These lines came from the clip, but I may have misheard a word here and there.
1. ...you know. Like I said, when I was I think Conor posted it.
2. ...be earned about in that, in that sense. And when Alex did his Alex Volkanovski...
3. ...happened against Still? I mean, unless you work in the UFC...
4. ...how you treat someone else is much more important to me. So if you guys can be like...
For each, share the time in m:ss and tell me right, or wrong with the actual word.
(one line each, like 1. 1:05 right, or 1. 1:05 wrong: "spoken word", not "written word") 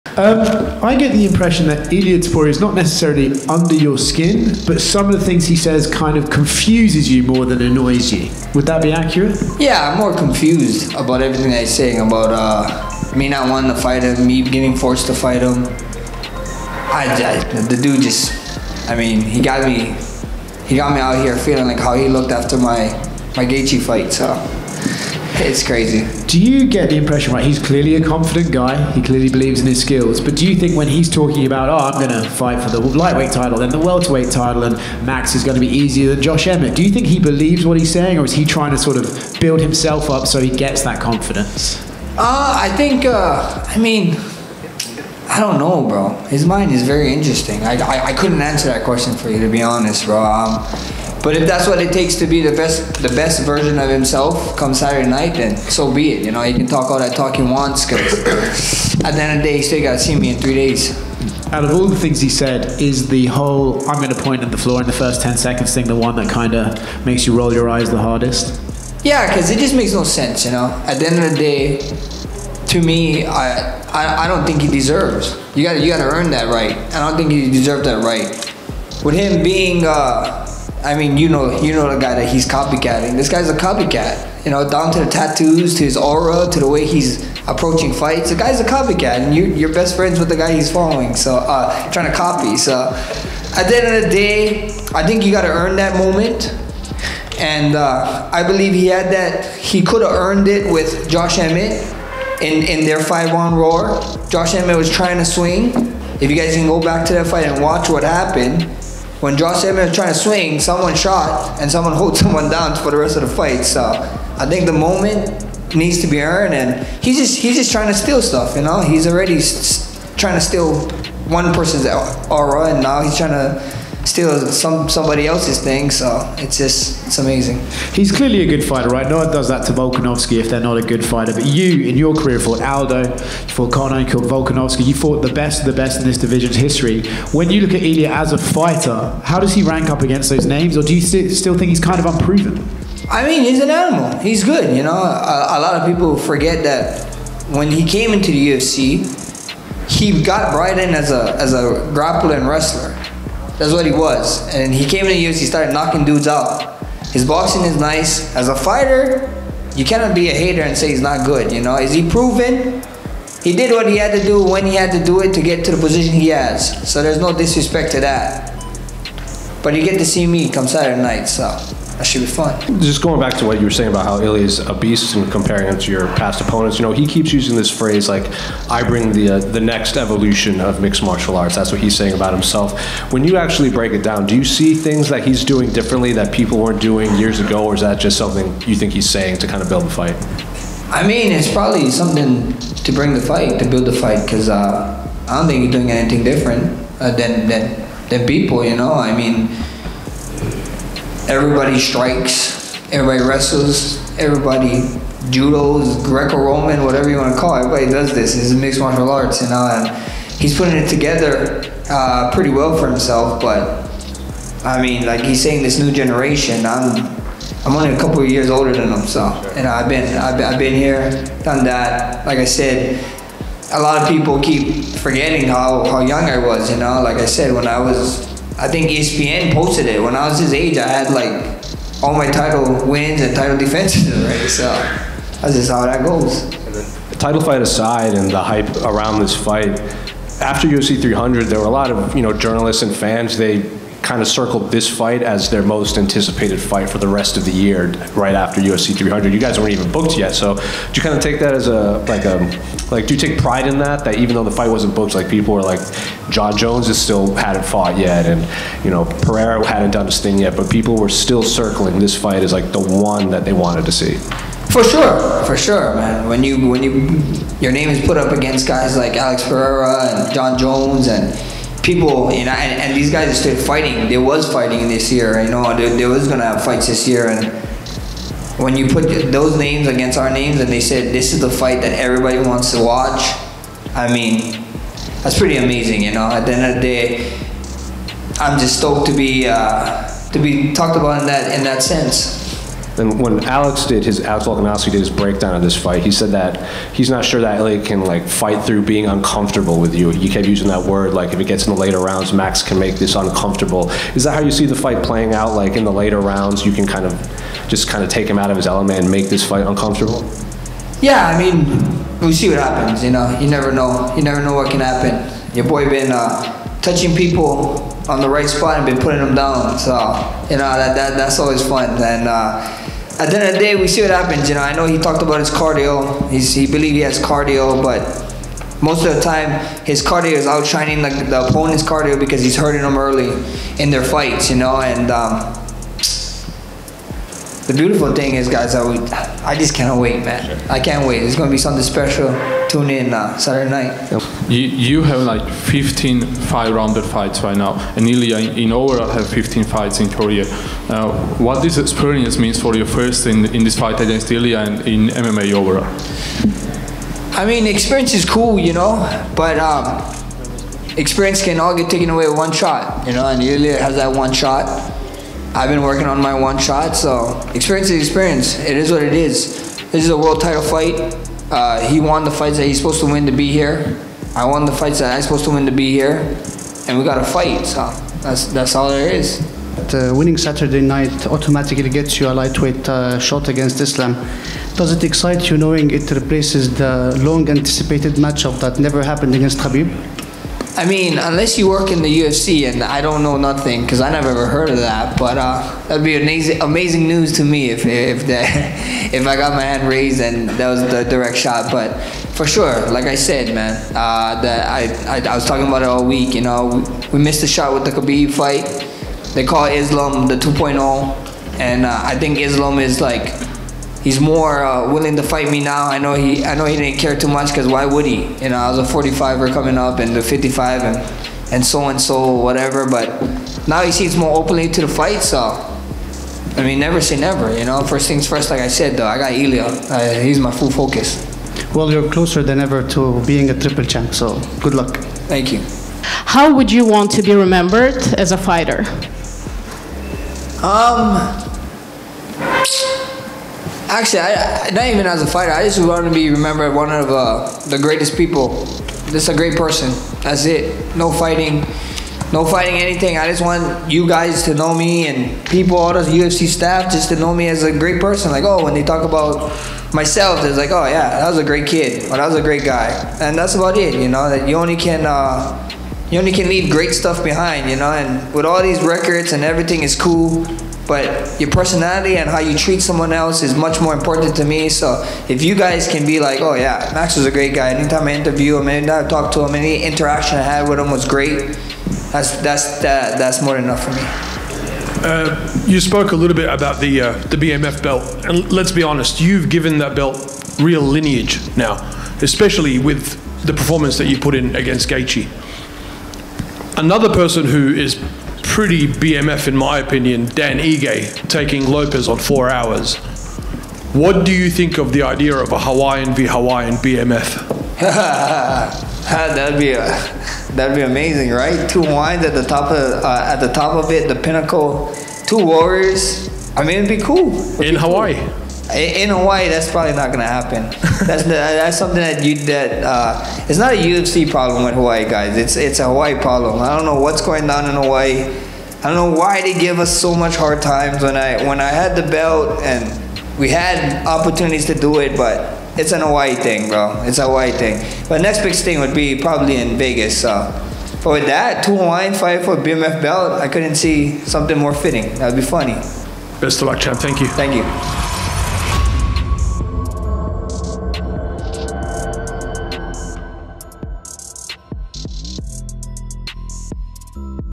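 1. 3:46 wrong: "ESPN", not "Conor"
2. 4:50 wrong: "talked", not "earned"
3. 6:29 wrong: "Khabib", not "Still"
4. 7:52 right.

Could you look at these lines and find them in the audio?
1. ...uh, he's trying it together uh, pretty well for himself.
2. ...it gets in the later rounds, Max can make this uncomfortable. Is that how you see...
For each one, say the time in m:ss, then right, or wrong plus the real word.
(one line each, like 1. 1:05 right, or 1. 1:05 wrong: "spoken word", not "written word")
1. 3:29 wrong: "putting", not "trying"
2. 5:01 right.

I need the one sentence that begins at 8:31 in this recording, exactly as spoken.
Two wines at the top of uh, at the top of it, the pinnacle.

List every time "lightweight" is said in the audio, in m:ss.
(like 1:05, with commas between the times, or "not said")
0:32, 6:22.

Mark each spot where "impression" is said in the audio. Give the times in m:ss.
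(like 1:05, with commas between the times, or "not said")
0:01, 0:26.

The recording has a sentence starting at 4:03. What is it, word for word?
They kind of circled this fight as their most anticipated fight for the rest of the year, right after UFC 300.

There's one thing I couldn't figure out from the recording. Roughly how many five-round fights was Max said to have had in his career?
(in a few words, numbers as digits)
15.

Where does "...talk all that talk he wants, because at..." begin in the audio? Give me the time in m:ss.
0:56.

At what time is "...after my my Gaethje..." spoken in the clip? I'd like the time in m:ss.
0:22.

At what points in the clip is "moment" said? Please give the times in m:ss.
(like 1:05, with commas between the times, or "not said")
1:35, 1:54.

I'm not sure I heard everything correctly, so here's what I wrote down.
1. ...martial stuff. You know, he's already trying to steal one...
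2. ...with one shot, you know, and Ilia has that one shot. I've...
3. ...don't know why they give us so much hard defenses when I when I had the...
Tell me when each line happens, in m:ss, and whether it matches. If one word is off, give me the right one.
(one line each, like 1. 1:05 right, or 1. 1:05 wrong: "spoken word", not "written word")
1. 1:57 wrong: "steal", not "martial"
2. 6:02 right
3. 8:48 wrong: "times", not "defenses".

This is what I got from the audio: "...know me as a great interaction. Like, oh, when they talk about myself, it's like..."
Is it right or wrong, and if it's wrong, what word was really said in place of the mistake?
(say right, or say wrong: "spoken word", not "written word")
wrong: "person", not "interaction".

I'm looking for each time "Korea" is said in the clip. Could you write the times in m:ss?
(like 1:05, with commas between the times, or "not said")
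5:50.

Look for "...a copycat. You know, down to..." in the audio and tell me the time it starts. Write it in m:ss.
1:23.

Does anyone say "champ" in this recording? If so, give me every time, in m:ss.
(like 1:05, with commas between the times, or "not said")
7:13, 9:06.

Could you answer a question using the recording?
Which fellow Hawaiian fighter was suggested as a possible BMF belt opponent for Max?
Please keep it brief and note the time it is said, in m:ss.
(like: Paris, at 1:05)
Dan Ige, at 8:20.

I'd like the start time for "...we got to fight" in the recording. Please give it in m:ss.
6:16.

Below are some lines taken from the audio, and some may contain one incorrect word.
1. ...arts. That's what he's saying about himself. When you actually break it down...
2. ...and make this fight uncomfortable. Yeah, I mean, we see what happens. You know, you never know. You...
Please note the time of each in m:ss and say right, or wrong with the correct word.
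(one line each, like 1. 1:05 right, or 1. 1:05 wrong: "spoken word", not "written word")
1. 3:01 right
2. 5:08 right.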